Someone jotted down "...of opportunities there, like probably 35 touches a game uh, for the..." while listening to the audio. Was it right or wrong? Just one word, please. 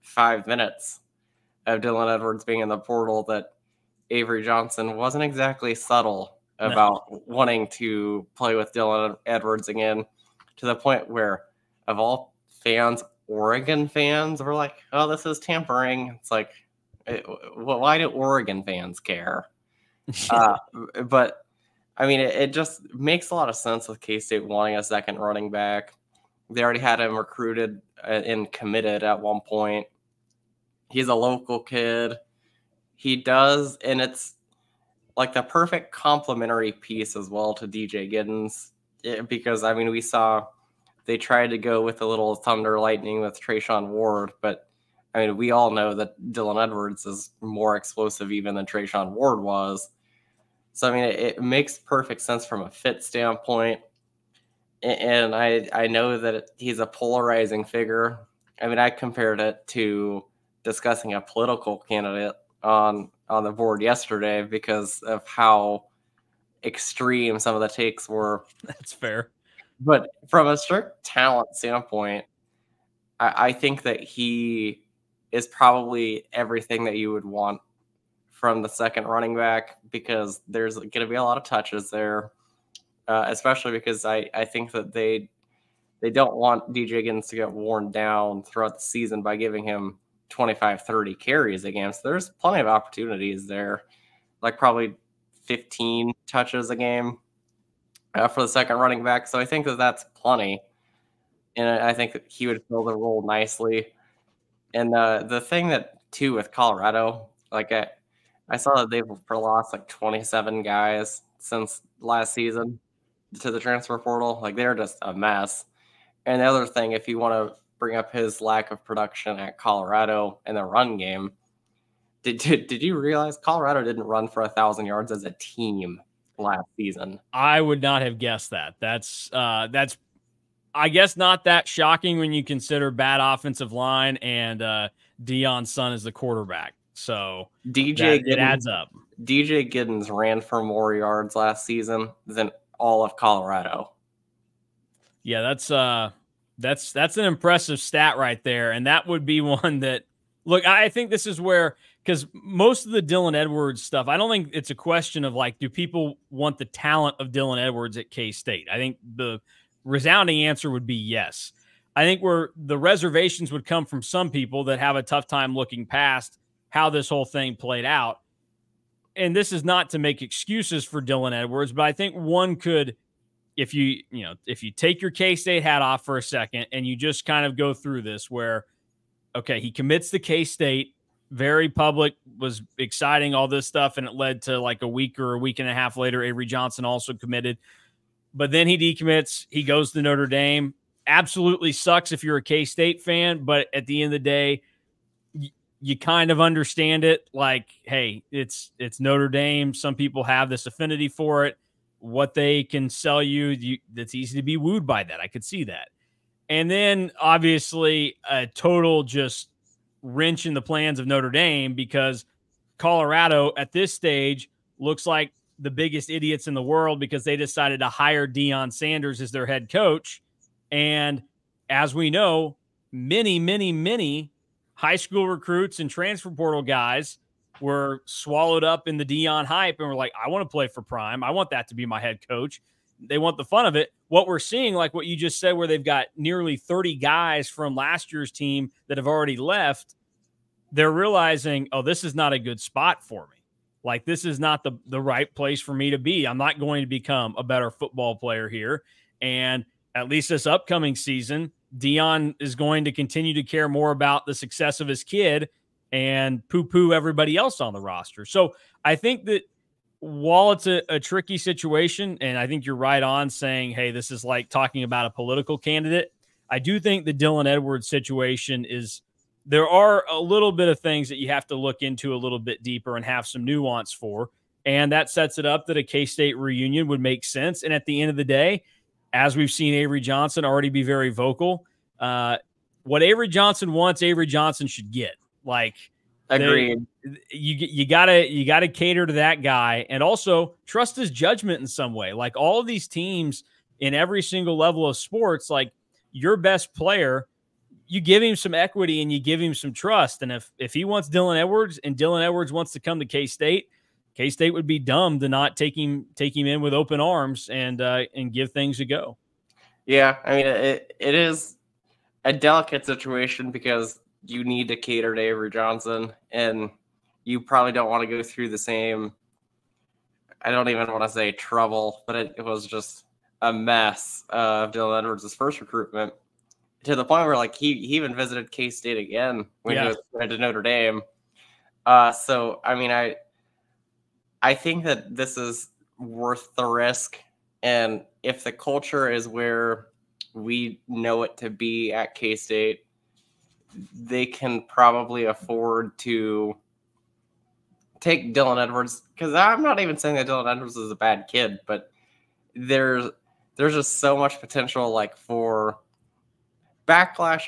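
wrong.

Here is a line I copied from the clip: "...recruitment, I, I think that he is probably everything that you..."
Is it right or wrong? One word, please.
wrong.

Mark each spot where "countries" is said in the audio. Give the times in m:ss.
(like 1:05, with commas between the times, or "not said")
not said.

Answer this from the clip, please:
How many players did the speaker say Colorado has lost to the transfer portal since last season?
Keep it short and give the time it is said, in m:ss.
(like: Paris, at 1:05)
27, at 1:49.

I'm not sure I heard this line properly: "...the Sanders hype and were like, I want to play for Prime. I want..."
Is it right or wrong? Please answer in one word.
wrong.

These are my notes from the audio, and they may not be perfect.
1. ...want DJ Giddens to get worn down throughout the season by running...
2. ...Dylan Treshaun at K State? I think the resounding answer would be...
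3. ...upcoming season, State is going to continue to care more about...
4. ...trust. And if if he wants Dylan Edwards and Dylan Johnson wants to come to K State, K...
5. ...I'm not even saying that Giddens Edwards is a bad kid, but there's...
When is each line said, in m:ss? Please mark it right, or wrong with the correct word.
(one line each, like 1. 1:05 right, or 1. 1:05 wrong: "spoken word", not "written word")
1. 1:26 wrong: "giving", not "running"
2. 2:37 wrong: "Edwards", not "Treshaun"
3. 4:10 wrong: "Deion", not "State"
4. 4:59 wrong: "Edwards", not "Johnson"
5. 5:49 wrong: "Dylan", not "Giddens".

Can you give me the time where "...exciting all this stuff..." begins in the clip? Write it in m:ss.
3:02.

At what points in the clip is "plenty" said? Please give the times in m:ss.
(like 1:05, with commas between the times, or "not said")
1:32, 1:40.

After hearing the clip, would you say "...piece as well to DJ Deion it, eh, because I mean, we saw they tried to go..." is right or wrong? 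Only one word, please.
wrong.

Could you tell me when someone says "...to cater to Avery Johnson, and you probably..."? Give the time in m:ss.
5:14.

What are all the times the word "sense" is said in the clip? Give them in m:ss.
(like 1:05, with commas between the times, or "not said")
0:23, 0:52, 4:37.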